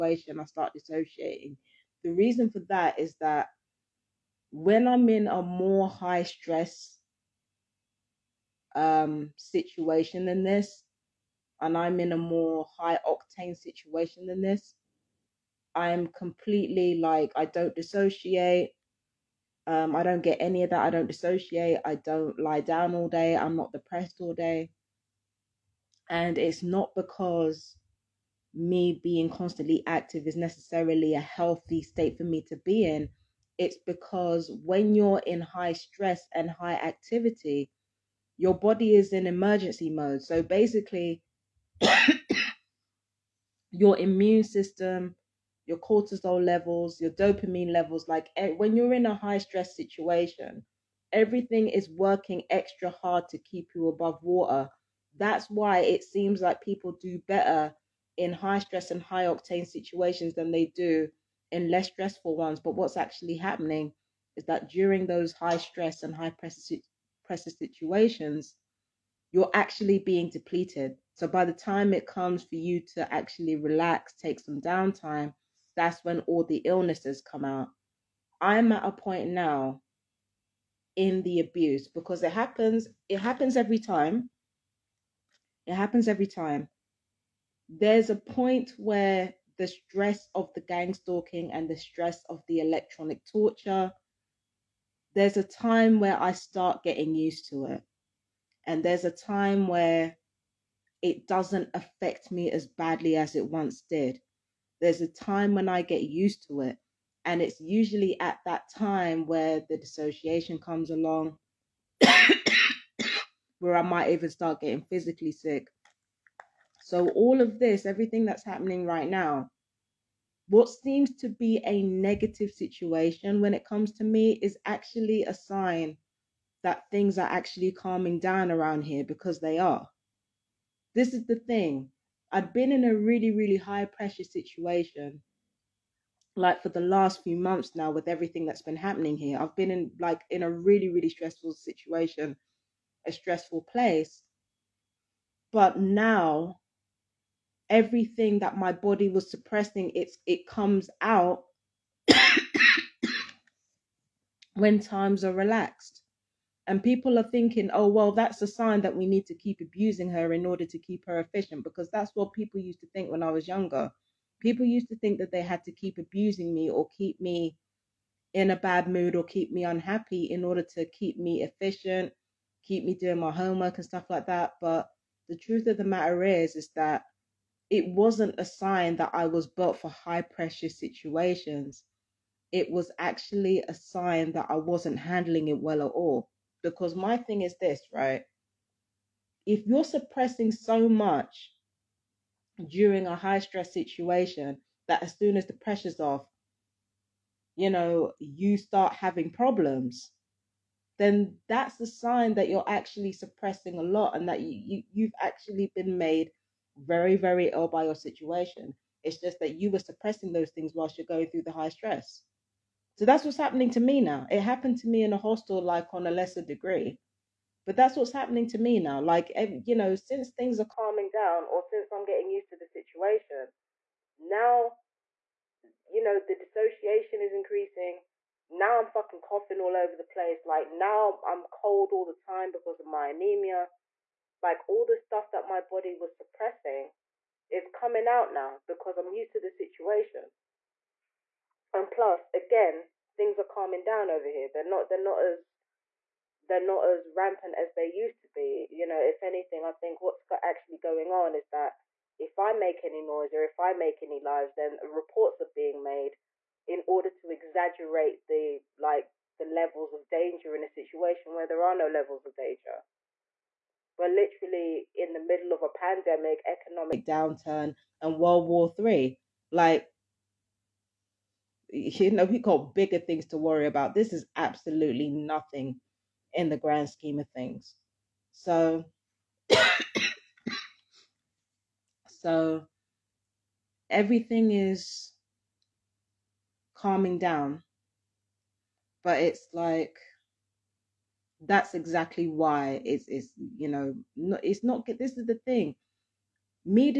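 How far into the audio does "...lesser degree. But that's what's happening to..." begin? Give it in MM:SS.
03:36.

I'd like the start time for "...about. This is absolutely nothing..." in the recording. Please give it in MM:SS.
04:33.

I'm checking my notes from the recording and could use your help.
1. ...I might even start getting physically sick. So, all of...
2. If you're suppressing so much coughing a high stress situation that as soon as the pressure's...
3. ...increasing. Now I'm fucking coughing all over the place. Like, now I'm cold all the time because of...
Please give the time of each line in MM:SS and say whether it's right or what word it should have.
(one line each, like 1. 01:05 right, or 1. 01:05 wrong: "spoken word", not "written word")
1. 01:53 right
2. 03:09 wrong: "during", not "coughing"
3. 03:47 right.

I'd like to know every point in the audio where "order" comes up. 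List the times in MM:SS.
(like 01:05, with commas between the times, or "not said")
02:40, 02:50, 04:16.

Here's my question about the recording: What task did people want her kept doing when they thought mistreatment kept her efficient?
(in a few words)
homework.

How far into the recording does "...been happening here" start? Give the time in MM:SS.
02:18.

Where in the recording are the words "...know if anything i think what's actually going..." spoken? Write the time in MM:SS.
04:08.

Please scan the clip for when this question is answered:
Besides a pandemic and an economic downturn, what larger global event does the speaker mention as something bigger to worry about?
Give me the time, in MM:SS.
04:28.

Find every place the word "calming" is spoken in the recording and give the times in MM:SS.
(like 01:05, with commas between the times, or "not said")
02:07, 03:40, 04:03, 04:46.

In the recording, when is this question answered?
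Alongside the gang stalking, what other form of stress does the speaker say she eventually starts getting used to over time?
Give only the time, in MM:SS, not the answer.
01:32.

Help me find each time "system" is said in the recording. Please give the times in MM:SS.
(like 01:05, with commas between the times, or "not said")
00:44.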